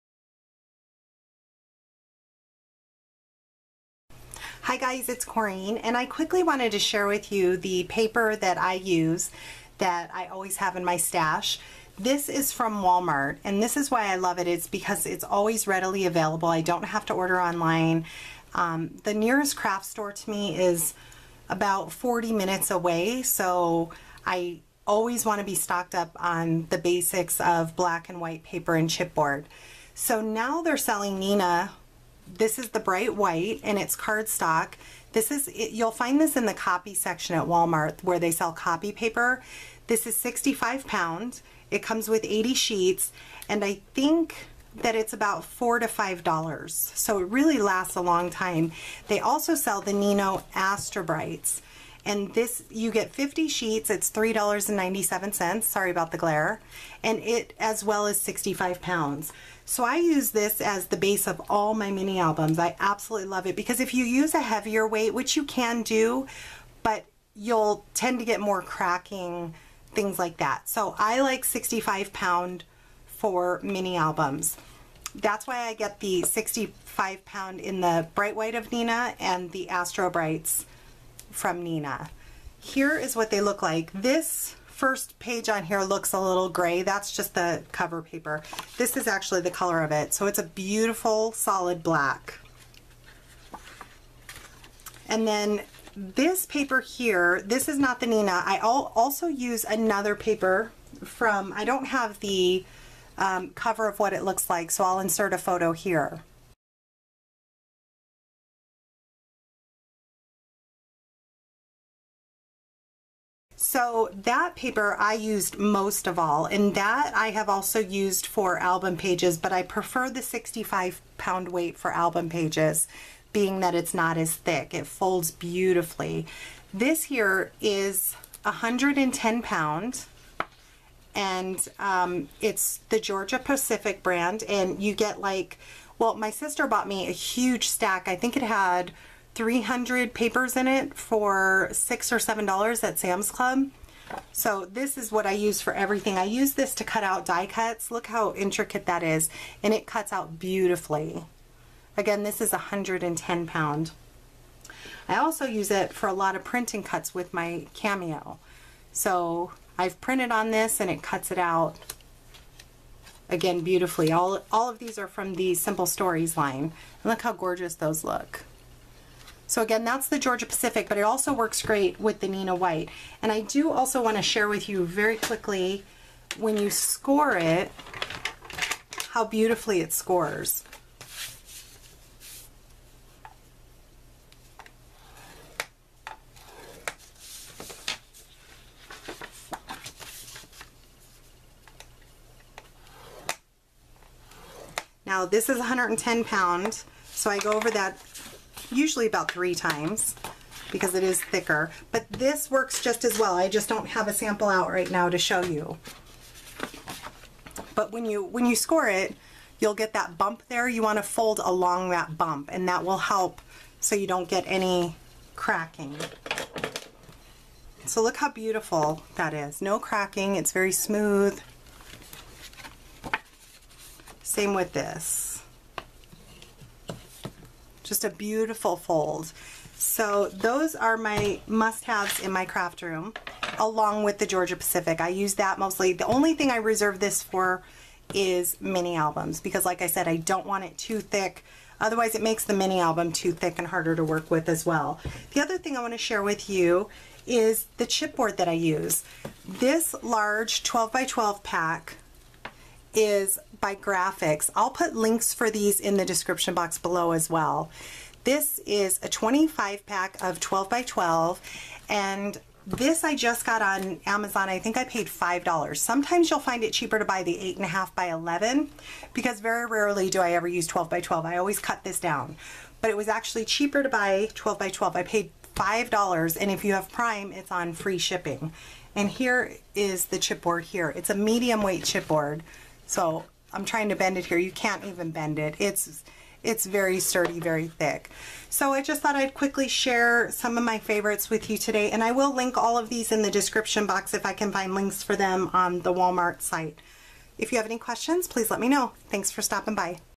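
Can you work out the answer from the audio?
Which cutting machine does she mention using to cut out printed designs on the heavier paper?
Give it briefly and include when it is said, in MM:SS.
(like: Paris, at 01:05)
Cameo, at 02:37.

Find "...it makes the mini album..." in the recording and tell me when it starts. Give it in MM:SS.
04:02.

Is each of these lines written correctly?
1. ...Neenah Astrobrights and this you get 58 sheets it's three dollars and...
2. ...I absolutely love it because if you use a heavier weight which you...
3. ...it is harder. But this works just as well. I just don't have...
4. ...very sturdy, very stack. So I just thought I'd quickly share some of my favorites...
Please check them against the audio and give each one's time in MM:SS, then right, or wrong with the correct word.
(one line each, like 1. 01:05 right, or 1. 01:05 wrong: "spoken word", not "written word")
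1. 00:49 wrong: "50", not "58"
2. 01:02 right
3. 03:20 wrong: "thicker", not "harder"
4. 04:46 wrong: "thick", not "stack".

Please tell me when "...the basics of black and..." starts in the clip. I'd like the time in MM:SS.
00:26.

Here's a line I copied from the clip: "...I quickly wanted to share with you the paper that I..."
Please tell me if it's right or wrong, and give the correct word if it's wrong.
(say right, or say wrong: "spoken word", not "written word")
right.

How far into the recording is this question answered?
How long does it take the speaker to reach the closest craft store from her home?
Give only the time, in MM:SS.
00:21.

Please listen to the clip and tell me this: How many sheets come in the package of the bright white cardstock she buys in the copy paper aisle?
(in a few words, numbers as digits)
80.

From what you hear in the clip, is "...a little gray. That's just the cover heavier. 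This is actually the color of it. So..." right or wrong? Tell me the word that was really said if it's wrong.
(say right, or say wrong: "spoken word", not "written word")
wrong: "paper", not "heavier".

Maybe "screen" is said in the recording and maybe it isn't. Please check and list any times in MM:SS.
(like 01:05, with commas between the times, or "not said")
not said.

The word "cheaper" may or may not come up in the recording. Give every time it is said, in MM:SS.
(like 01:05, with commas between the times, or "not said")
04:26, 04:33.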